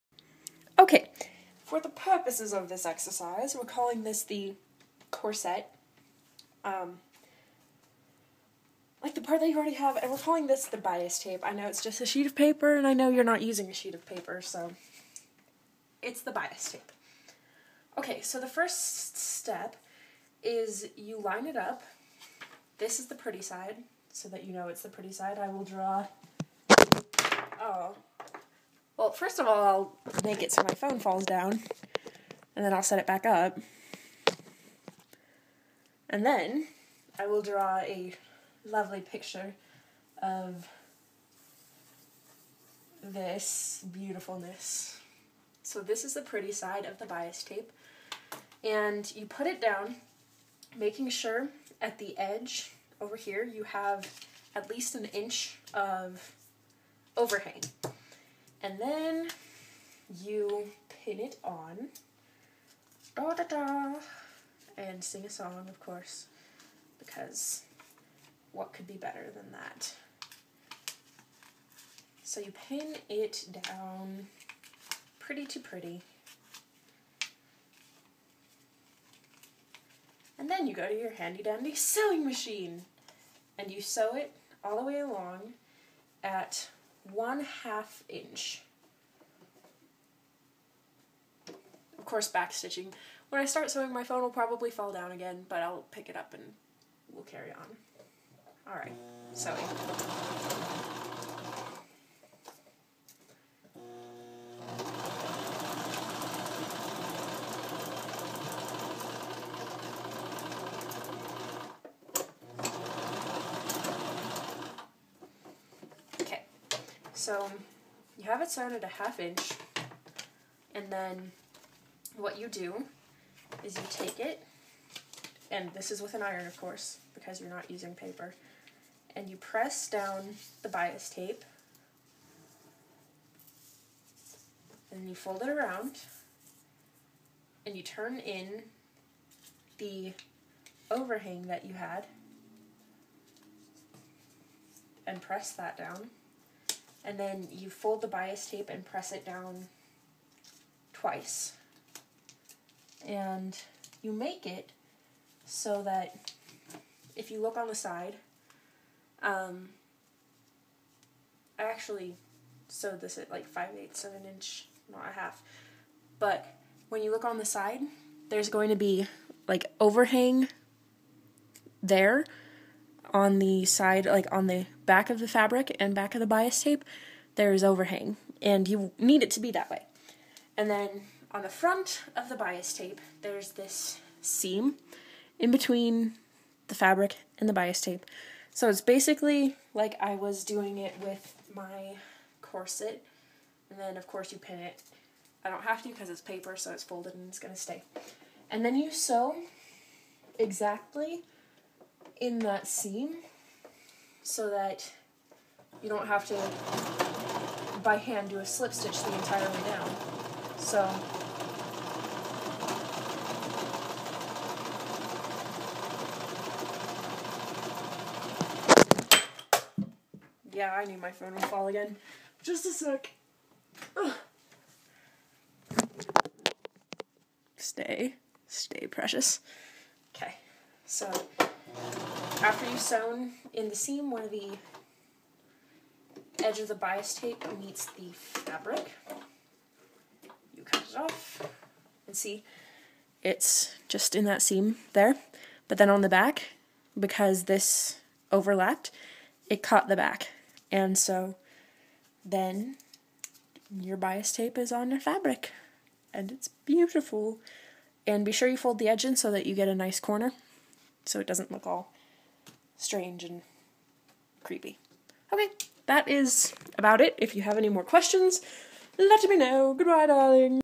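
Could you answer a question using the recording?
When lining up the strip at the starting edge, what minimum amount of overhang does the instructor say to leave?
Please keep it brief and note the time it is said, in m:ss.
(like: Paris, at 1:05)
1 inch, at 0:54.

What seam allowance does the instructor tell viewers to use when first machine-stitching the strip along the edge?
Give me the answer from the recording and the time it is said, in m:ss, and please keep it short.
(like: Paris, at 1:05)
1/2 inch, at 1:27.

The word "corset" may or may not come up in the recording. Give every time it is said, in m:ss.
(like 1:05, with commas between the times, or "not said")
0:05, 3:12.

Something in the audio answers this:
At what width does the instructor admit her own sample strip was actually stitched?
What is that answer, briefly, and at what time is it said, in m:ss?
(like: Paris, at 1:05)
5/8 of an inch, at 2:43.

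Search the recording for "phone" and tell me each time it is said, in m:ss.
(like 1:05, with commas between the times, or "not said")
0:30, 1:34, 3:41.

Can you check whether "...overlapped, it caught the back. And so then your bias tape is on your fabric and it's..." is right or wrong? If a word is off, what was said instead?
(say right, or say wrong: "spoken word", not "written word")
right.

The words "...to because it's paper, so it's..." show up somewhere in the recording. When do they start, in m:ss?
3:15.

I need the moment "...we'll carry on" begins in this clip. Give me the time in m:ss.
1:37.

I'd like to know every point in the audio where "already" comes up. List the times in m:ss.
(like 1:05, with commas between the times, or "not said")
0:09.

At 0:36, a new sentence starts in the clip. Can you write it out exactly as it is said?
And then I will draw a lovely picture of this beautifulness.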